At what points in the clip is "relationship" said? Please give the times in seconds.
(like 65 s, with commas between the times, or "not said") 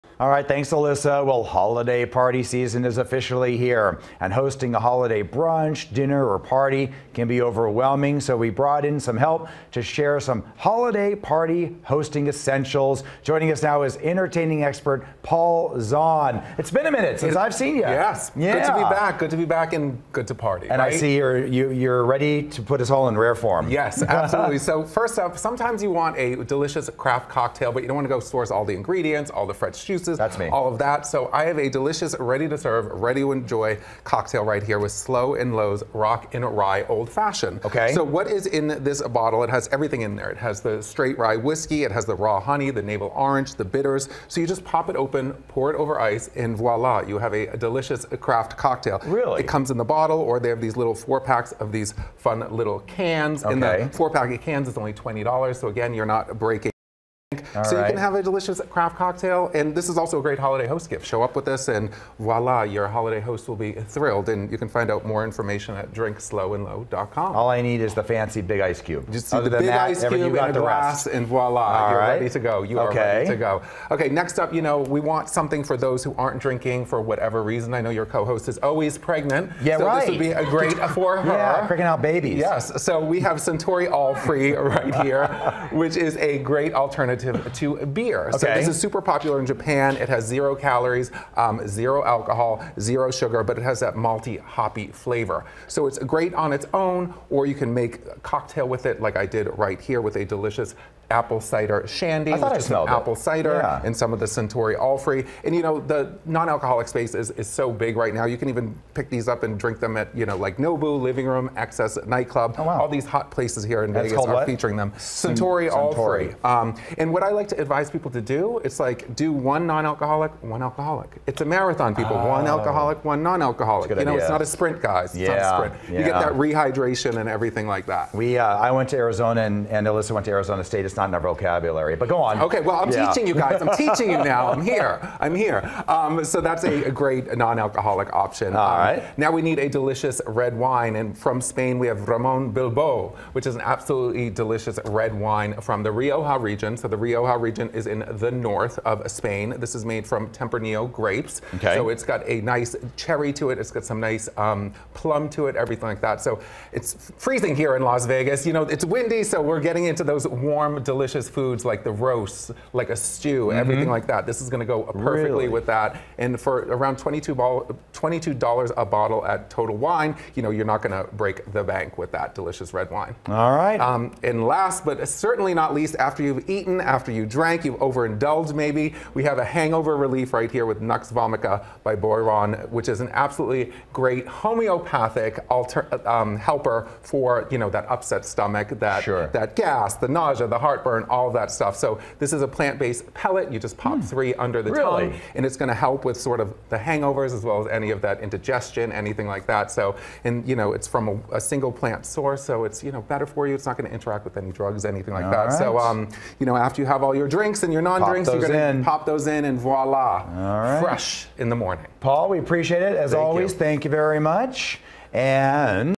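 not said.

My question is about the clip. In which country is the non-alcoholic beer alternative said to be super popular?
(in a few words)
Japan.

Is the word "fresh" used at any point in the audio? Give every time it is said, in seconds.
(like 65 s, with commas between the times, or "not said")
29 s, 210 s.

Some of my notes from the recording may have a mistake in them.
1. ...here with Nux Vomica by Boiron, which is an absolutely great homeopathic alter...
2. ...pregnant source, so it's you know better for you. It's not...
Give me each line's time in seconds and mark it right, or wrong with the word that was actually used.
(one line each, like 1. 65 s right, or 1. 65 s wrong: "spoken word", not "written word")
1. 180 s right
2. 201 s wrong: "plant", not "pregnant".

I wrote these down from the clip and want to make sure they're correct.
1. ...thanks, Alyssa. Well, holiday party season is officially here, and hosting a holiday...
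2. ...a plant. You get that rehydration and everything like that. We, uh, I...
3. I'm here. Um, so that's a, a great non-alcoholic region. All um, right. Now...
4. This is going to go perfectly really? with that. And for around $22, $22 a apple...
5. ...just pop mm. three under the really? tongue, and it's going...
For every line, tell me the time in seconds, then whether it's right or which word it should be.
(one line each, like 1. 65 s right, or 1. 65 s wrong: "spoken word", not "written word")
1. 0 s right
2. 125 s wrong: "sprint", not "plant"
3. 135 s wrong: "option", not "region"
4. 164 s wrong: "bottle", not "apple"
5. 193 s right.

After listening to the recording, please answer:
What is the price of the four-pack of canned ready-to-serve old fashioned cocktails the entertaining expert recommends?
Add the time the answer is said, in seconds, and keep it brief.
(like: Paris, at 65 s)
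$20, at 54 s.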